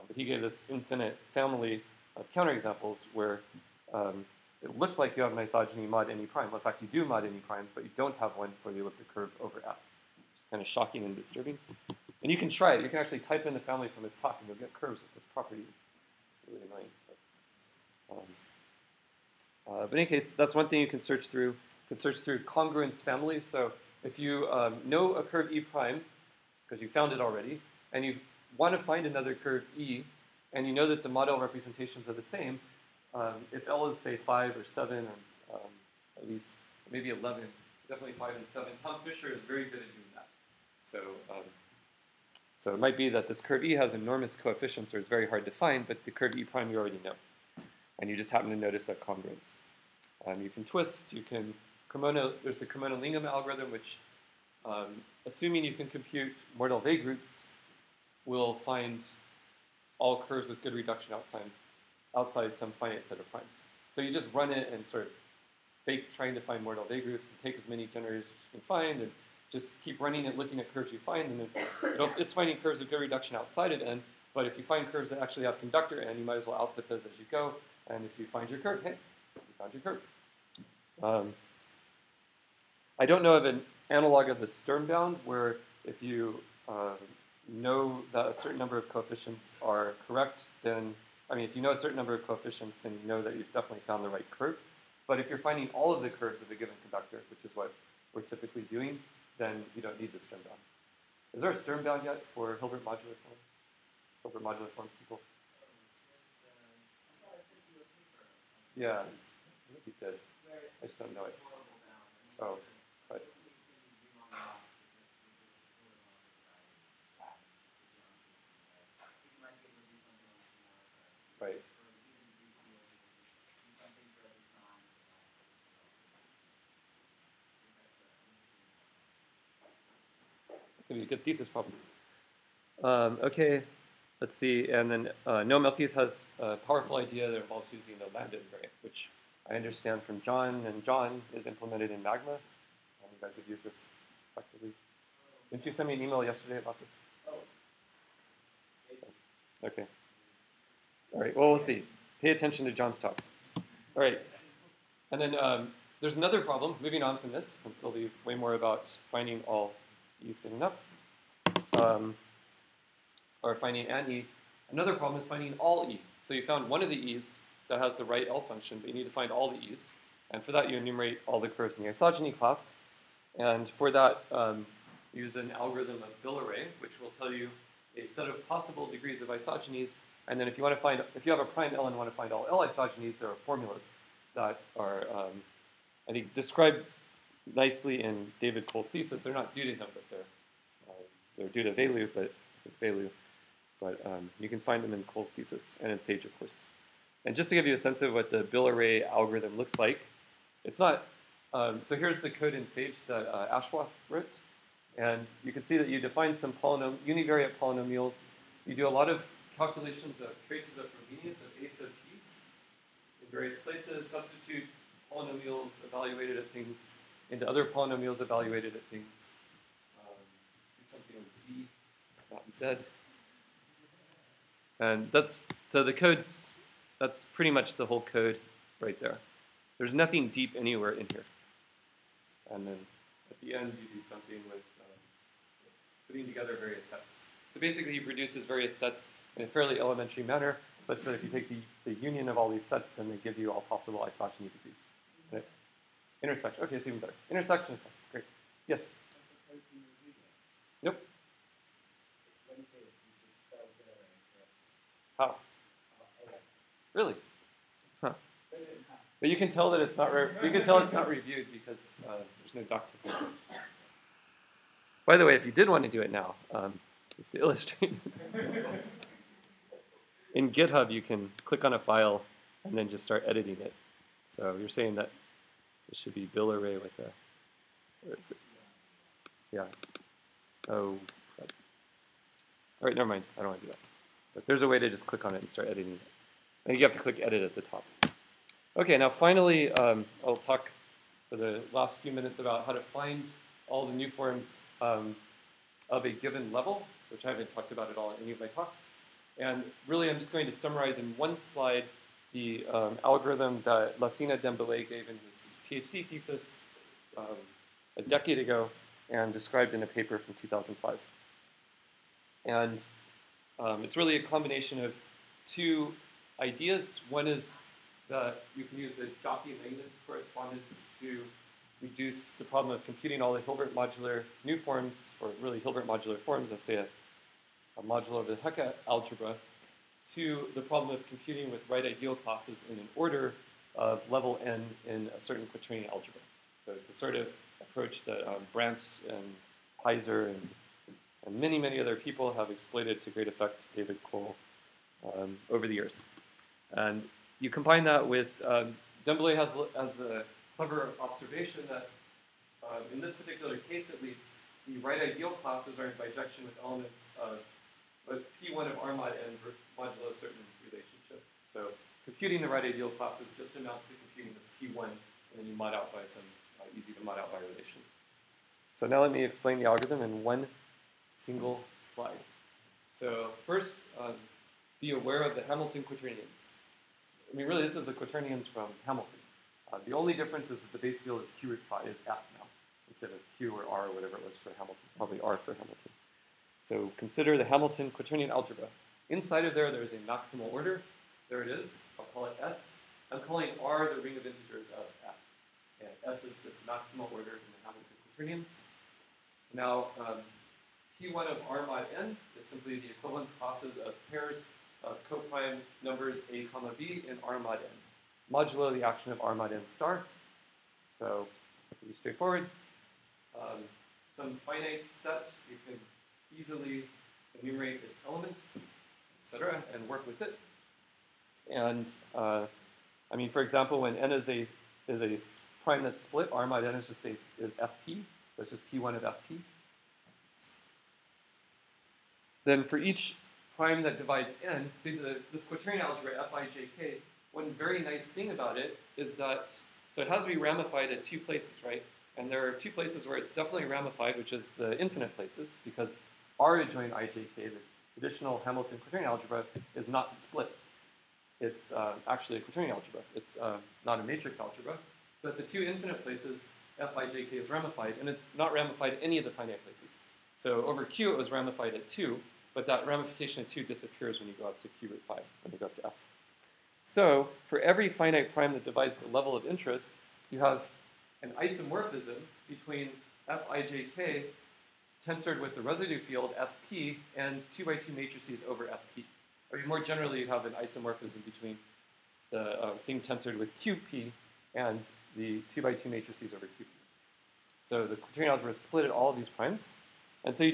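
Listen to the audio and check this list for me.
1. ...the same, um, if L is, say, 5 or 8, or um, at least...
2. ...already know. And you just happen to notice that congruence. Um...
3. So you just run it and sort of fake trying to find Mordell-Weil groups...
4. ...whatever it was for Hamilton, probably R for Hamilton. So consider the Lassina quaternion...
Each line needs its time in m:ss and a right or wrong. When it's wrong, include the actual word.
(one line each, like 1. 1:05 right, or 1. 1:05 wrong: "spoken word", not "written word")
1. 0:32 wrong: "7", not "8"
2. 0:46 right
3. 1:03 right
4. 6:23 wrong: "Hamilton", not "Lassina".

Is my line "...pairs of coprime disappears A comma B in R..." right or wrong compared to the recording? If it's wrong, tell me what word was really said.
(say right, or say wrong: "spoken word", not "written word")
wrong: "numbers", not "disappears".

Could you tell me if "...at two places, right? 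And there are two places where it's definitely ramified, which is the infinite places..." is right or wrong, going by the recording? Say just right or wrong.
right.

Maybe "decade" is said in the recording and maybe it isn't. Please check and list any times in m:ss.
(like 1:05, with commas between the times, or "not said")
5:08.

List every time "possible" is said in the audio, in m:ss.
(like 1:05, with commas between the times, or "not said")
2:58, 4:03.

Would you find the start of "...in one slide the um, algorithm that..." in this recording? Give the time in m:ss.
5:00.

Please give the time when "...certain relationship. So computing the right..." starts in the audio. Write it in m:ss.
6:00.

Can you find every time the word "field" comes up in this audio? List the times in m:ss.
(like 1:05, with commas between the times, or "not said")
6:20, 7:55.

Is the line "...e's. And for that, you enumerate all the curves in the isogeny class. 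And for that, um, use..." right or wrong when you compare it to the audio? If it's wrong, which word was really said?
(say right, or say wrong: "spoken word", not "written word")
right.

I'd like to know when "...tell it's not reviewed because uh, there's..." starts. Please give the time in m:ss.
4:20.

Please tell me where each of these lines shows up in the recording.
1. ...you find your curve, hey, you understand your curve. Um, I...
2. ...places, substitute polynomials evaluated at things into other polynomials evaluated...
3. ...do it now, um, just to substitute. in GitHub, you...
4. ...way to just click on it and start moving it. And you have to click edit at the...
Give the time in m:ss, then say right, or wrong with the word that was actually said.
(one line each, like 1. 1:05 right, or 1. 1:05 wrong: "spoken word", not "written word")
1. 1:18 wrong: "found", not "understand"
2. 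3:33 right
3. 4:25 wrong: "illustrate", not "substitute"
4. 4:44 wrong: "editing", not "moving".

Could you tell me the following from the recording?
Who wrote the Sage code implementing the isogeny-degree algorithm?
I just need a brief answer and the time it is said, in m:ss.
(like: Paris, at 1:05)
Ashwath, at 3:23.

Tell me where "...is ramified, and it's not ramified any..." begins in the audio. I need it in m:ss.
7:37.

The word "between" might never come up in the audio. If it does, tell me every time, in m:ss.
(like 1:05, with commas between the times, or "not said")
7:52, 8:01.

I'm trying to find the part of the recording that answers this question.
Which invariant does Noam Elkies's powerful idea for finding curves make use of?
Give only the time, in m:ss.
2:18.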